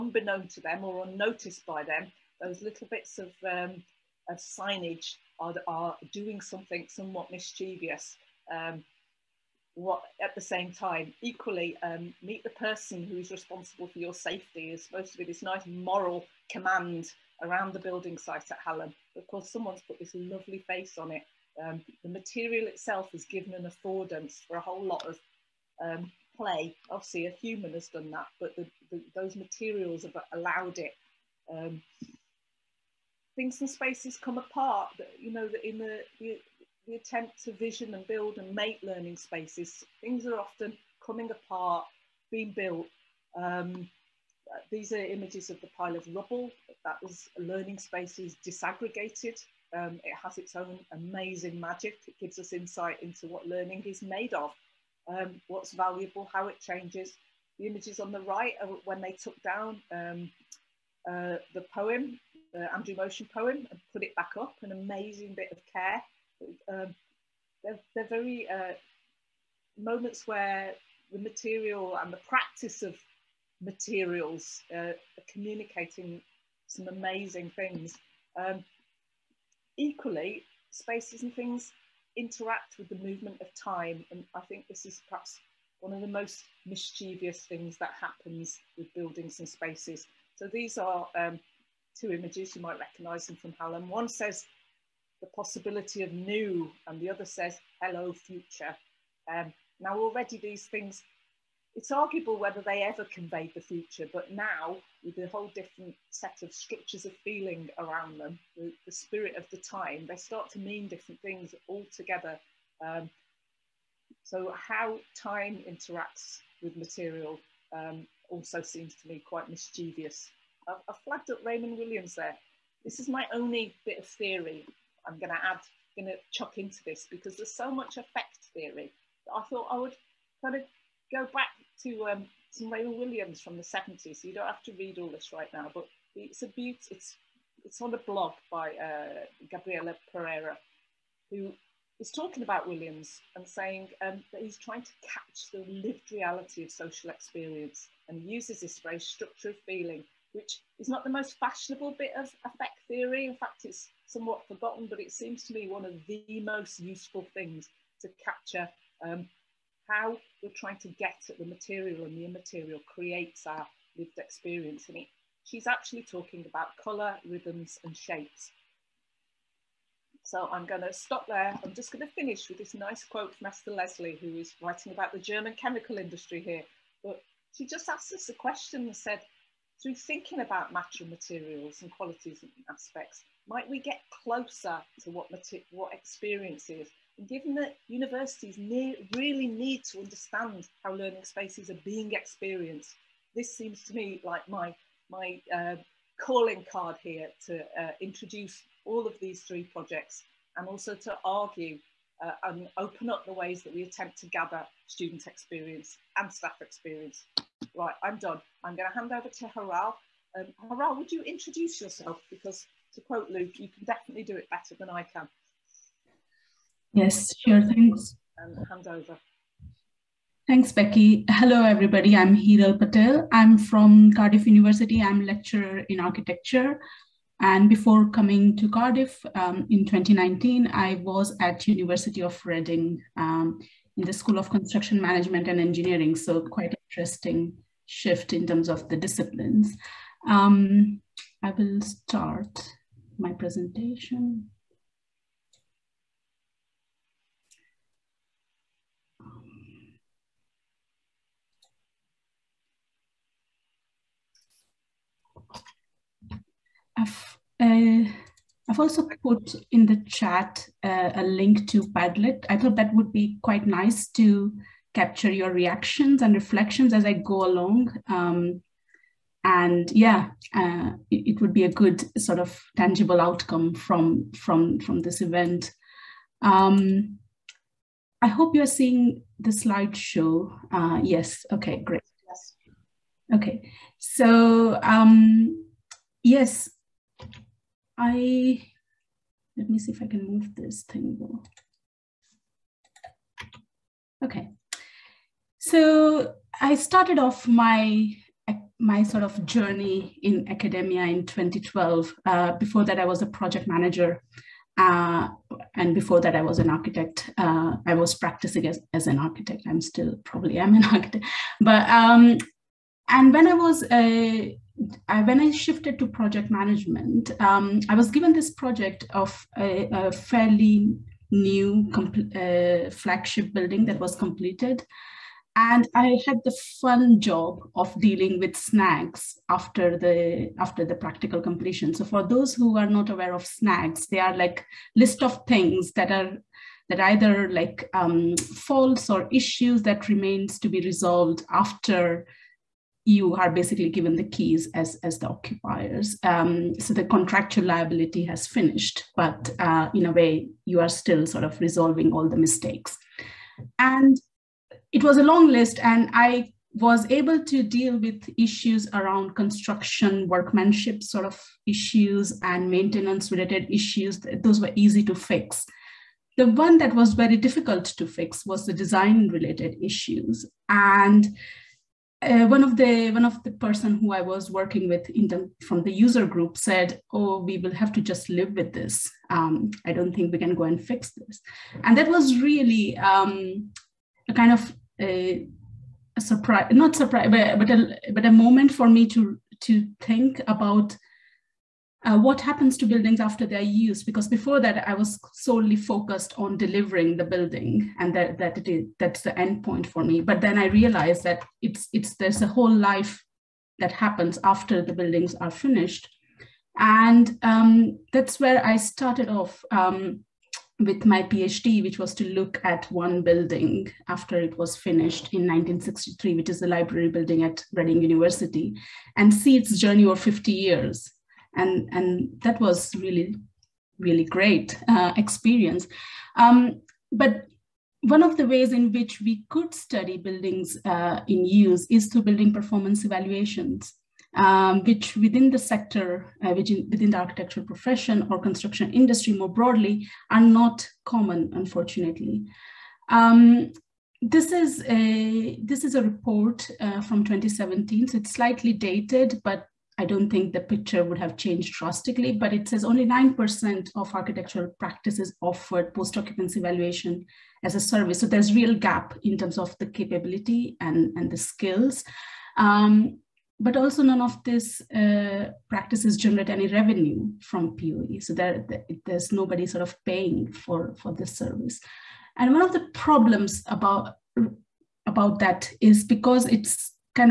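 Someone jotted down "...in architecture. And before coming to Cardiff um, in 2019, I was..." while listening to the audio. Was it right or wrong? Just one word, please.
right.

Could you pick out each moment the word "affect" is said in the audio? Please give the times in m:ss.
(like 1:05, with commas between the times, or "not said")
2:07, 2:32.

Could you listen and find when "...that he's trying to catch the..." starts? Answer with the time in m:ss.
2:24.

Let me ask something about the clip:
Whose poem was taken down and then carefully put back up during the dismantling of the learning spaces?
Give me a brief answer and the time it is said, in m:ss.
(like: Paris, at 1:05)
Andrew Motion, at 1:02.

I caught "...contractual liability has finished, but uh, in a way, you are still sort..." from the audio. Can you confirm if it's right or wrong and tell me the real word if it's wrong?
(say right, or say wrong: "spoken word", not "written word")
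right.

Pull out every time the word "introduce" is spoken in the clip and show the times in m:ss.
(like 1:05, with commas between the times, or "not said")
3:18, 3:31.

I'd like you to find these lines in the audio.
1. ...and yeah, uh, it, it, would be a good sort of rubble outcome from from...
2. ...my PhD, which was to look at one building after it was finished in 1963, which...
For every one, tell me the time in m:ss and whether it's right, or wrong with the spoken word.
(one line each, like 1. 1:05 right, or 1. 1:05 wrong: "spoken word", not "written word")
1. 4:29 wrong: "tangible", not "rubble"
2. 6:51 right.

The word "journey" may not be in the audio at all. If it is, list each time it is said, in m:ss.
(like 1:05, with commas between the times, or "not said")
4:59, 6:59.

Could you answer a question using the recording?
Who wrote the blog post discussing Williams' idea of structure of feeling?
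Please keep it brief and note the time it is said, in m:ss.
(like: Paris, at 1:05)
Gabriela Pereira, at 2:19.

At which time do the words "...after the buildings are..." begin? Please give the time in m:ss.
6:44.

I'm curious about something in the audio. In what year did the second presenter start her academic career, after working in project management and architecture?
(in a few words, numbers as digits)
2012.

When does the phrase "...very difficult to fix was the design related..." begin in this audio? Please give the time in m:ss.
6:07.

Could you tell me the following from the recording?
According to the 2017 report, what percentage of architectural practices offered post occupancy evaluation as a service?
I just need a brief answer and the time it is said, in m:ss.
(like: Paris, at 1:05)
9%, at 7:33.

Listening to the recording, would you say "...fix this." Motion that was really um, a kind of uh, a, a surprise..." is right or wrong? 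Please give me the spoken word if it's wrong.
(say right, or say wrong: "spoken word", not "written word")
wrong: "And", not "Motion".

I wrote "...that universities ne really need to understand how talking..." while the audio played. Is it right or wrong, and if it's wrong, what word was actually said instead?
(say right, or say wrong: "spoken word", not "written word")
wrong: "learning", not "talking".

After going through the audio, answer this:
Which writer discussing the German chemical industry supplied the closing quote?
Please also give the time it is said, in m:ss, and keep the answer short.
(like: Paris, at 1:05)
Esther Leslie, at 2:53.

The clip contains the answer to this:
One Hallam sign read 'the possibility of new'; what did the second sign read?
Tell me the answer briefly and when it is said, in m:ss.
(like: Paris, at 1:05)
hello future, at 1:37.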